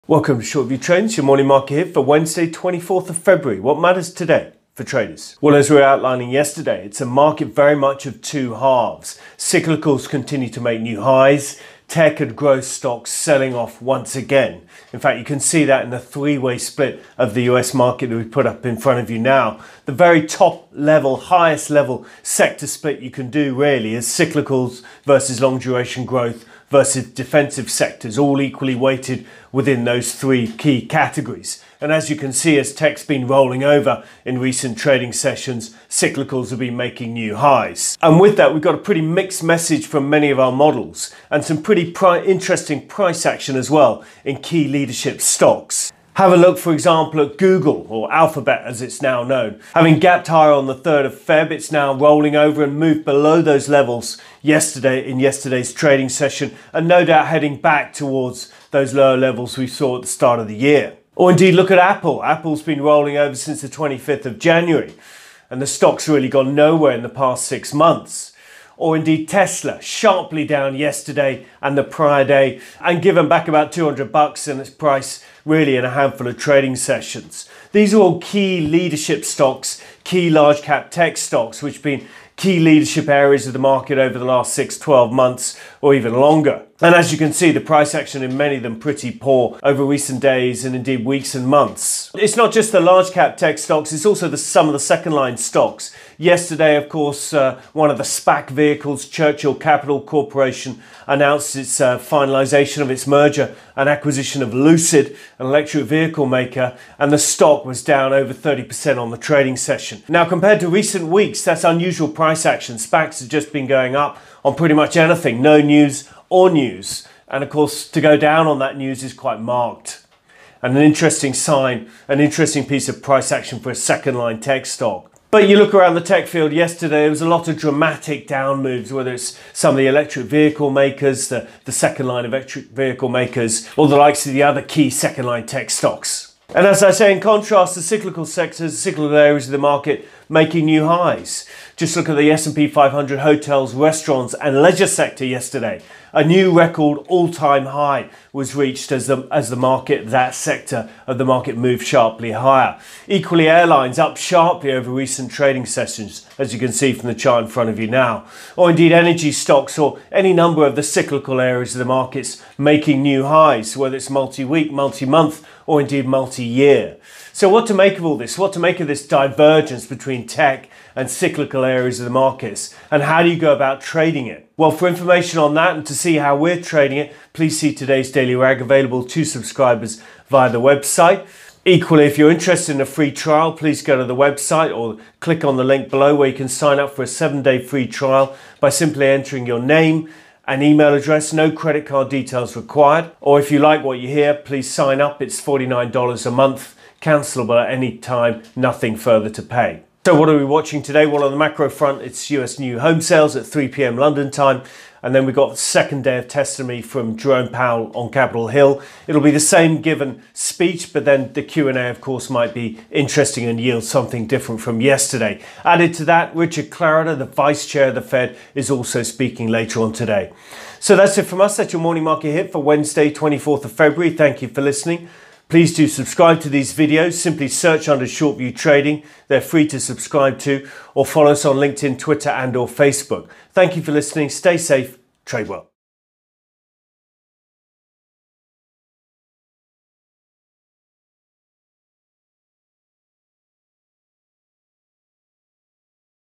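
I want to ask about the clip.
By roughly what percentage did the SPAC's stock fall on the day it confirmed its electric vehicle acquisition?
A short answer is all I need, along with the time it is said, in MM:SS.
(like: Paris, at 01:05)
over 30%, at 01:48.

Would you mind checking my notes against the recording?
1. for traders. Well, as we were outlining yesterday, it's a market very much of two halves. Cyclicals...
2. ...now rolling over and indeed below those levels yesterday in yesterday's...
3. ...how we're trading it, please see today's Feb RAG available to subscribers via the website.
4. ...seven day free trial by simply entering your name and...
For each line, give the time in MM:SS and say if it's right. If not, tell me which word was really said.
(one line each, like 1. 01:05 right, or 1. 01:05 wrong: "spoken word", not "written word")
1. 00:04 right
2. 00:51 wrong: "moved", not "indeed"
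3. 02:56 wrong: "Daily", not "Feb"
4. 03:07 right.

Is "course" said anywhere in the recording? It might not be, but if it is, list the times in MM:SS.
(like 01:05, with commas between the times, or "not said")
01:36, 01:57, 03:32.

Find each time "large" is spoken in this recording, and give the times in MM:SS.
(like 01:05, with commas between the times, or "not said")
01:20, 01:32.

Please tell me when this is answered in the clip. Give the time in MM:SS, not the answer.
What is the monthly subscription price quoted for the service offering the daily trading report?
03:15.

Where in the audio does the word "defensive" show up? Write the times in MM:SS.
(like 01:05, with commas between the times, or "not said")
00:27.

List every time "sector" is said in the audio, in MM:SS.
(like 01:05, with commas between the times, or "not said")
00:22, 00:27, 02:18, 02:24, 02:30.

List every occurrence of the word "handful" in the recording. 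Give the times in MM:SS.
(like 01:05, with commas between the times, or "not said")
01:15.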